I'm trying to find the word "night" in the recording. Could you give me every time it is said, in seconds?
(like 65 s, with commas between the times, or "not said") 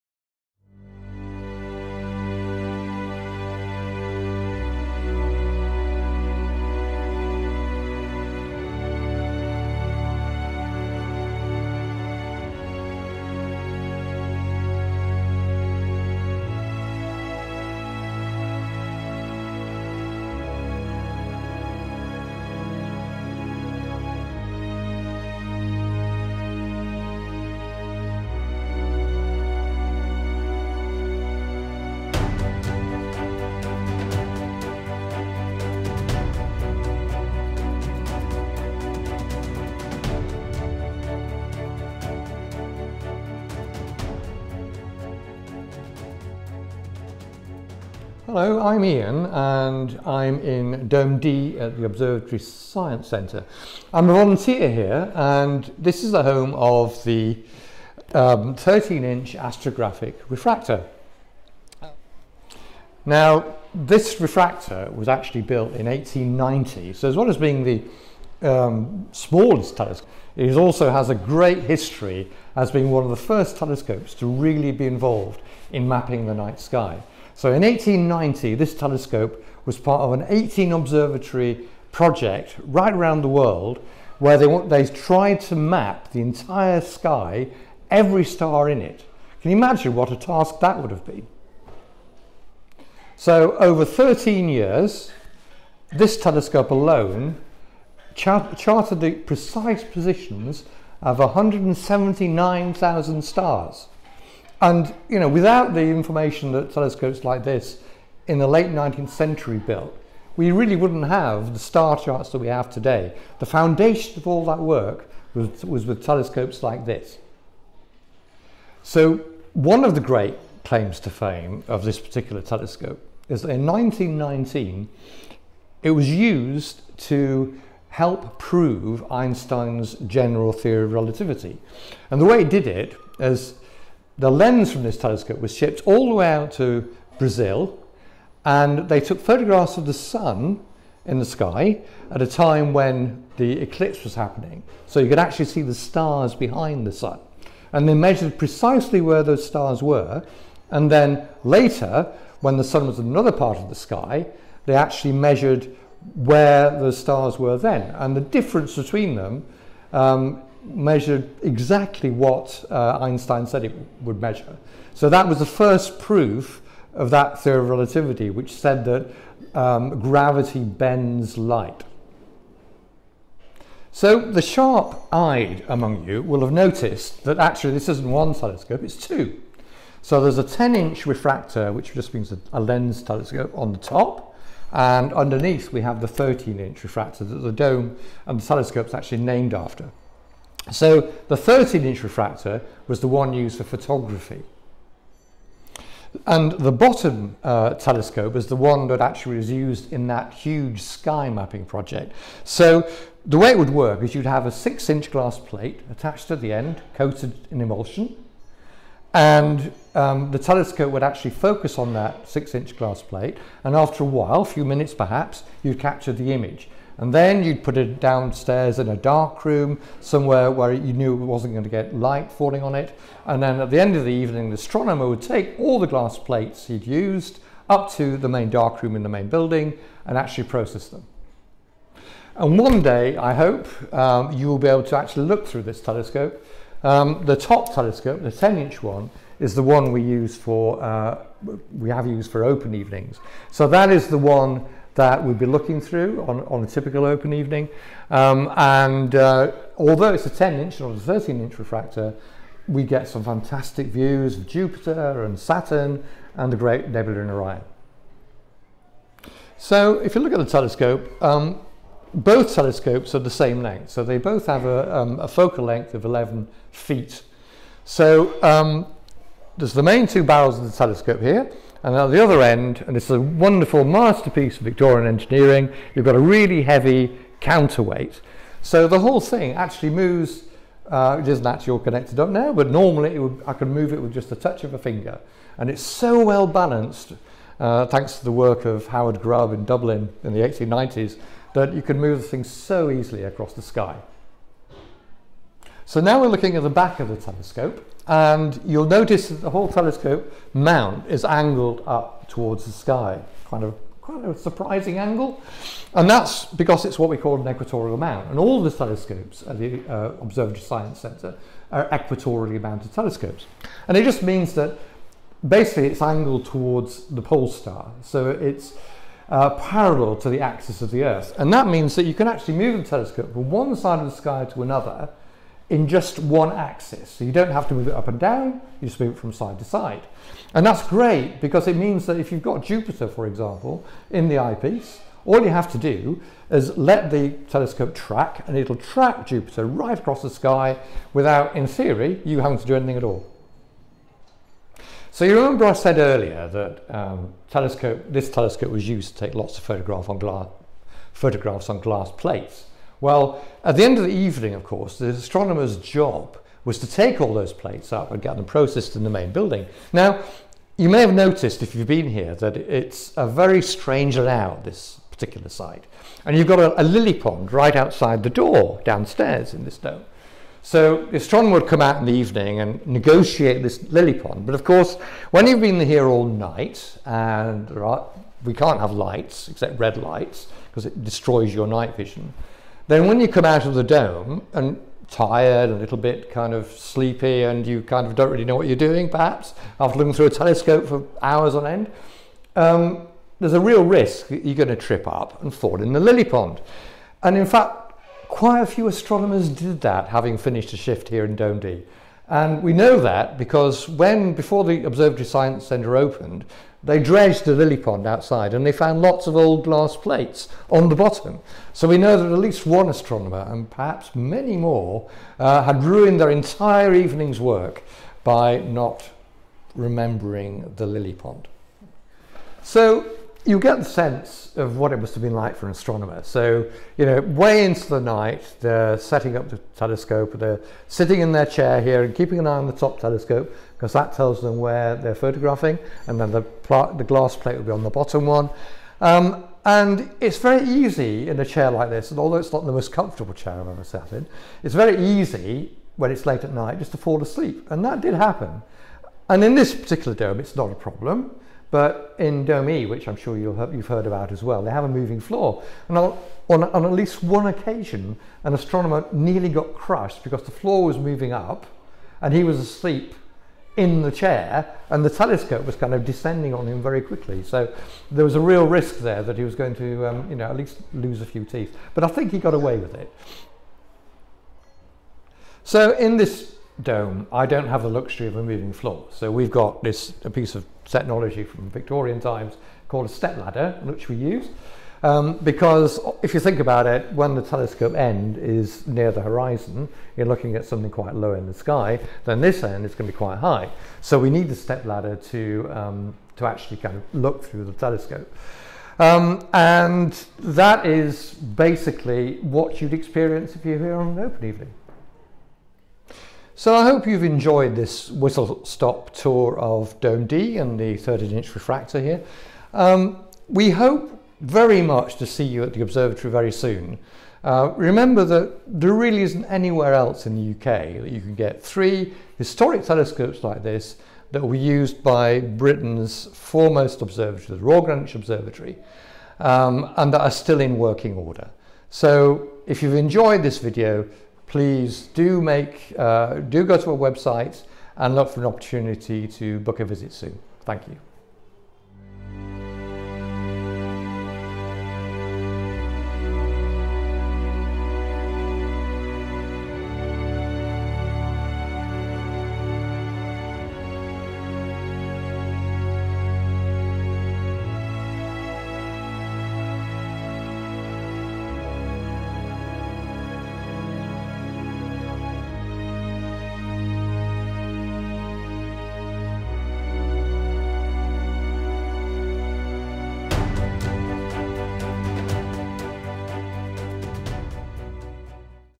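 76 s, 376 s, 381 s, 427 s, 446 s.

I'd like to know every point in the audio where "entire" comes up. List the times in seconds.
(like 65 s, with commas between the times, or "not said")
86 s, 416 s.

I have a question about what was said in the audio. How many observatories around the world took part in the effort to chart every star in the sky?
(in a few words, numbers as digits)
18.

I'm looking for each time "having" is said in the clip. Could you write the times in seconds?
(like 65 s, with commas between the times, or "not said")
342 s, 400 s.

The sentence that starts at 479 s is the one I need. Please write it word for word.
So we've got this a piece of technology from Victorian times called a step ladder, which we use.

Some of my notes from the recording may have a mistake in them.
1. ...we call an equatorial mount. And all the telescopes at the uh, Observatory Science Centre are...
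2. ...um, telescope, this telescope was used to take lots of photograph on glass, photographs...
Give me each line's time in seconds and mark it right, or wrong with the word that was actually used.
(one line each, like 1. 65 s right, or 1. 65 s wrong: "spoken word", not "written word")
1. 307 s right
2. 346 s right.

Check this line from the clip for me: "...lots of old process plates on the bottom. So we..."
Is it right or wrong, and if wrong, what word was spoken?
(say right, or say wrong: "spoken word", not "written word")
wrong: "glass", not "process".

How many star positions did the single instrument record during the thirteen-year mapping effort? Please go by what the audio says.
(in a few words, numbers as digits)
179,000.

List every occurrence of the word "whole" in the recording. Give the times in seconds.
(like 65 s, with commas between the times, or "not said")
278 s, 299 s.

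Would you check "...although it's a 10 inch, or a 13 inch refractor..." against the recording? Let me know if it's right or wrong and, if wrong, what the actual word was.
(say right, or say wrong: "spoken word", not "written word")
right.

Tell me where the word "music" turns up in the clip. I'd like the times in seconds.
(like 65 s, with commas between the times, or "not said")
not said.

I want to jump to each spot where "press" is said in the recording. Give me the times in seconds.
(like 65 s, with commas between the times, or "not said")
not said.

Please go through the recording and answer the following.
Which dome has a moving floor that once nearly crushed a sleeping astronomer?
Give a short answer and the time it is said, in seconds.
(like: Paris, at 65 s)
Dome E, at 452 s.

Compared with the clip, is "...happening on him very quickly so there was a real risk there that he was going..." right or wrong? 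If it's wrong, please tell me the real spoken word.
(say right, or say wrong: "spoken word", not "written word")
wrong: "descending", not "happening".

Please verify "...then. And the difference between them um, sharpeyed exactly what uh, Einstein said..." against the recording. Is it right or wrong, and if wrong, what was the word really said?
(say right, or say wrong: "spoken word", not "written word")
wrong: "measured", not "sharpeyed".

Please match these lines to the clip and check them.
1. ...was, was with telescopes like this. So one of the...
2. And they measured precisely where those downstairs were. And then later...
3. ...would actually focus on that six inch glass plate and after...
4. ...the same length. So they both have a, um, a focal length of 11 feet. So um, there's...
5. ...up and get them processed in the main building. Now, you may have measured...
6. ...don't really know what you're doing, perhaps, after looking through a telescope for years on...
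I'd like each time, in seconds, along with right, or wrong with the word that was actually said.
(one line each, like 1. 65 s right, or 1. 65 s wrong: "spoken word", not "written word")
1. 115 s right
2. 147 s wrong: "stars", not "downstairs"
3. 210 s right
4. 263 s right
5. 357 s wrong: "noticed", not "measured"
6. 388 s wrong: "hours", not "years".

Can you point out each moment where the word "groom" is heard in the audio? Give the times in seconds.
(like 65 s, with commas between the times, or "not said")
not said.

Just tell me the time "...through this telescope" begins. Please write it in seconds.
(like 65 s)
235 s.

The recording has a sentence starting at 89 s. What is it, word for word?
Can you imagine what a task that would have been?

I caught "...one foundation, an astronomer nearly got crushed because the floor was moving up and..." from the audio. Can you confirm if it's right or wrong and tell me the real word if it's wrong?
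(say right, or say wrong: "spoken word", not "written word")
wrong: "occasion", not "foundation".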